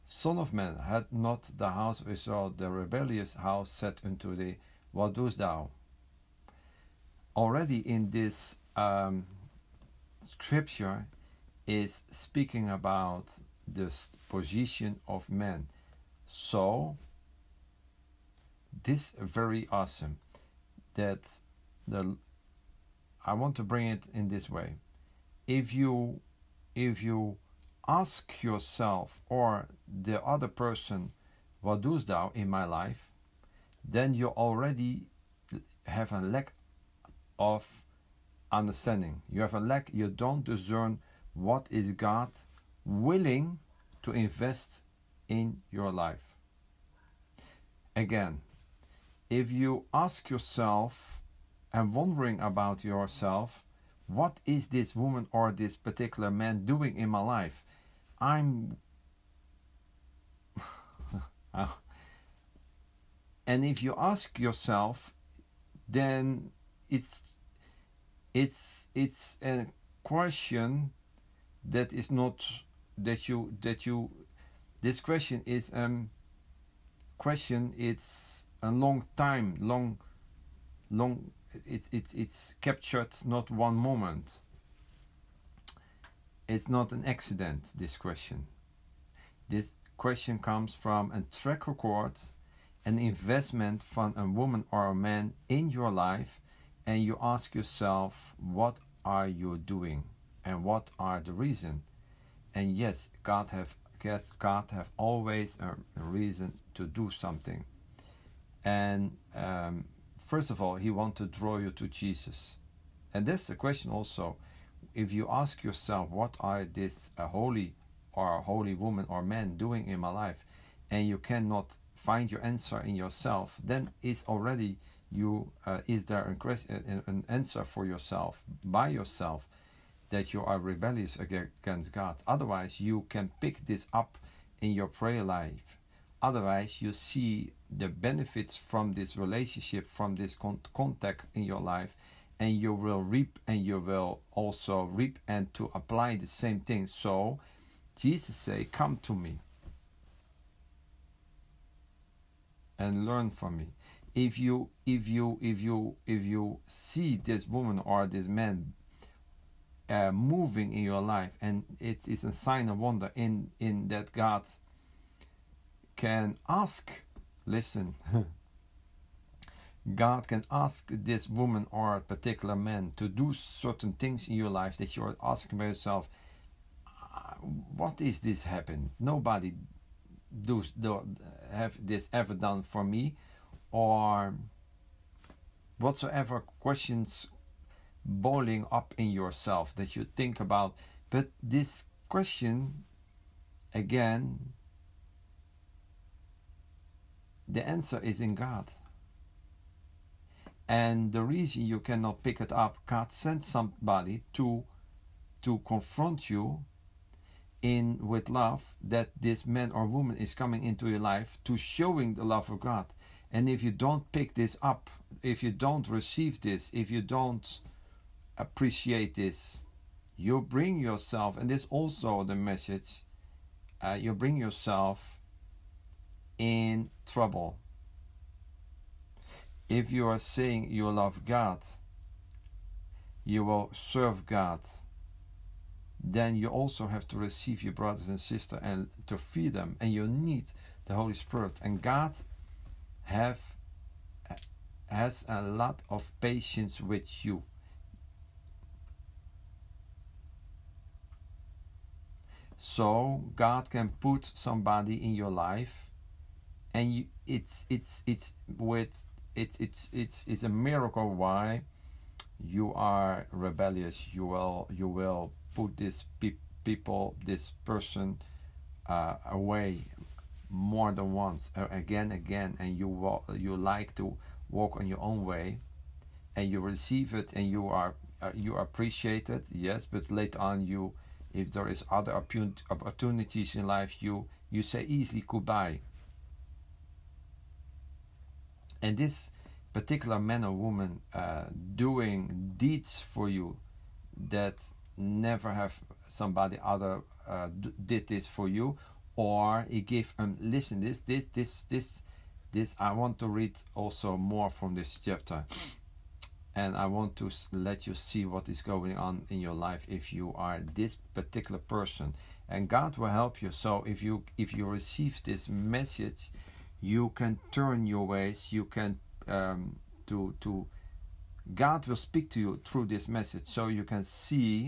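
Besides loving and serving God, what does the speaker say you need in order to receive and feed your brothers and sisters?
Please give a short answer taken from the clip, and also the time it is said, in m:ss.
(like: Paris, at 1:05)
the Holy Spirit, at 4:00.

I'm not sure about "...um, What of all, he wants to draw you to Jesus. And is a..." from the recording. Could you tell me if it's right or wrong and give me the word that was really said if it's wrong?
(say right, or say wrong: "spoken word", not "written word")
wrong: "First", not "What".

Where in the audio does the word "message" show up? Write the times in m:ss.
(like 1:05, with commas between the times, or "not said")
3:42, 5:15, 5:23.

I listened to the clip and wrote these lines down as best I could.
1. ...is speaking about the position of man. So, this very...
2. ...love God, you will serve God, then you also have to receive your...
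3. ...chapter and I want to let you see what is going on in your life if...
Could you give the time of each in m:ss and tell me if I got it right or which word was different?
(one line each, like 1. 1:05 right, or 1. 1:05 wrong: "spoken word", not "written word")
1. 0:11 right
2. 3:50 right
3. 5:05 right.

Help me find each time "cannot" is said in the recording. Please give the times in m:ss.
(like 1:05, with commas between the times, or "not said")
2:01, 3:21.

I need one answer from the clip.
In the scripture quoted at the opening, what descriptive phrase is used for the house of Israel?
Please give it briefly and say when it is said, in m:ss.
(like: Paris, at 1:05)
the rebellious house, at 0:02.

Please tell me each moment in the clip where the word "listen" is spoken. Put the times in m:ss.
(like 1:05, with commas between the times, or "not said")
2:47, 5:00.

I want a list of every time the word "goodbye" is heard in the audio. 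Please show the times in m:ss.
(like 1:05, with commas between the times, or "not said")
4:45.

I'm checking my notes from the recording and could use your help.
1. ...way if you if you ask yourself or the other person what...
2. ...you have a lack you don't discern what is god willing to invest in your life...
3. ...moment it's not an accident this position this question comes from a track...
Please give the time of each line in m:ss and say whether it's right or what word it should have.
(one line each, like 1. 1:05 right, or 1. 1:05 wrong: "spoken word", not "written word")
1. 0:24 right
2. 0:39 right
3. 1:23 wrong: "question", not "position".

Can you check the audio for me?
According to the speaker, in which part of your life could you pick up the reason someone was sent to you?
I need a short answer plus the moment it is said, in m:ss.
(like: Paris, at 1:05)
prayer life, at 2:14.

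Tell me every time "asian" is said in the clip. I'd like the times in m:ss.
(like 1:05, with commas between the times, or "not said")
not said.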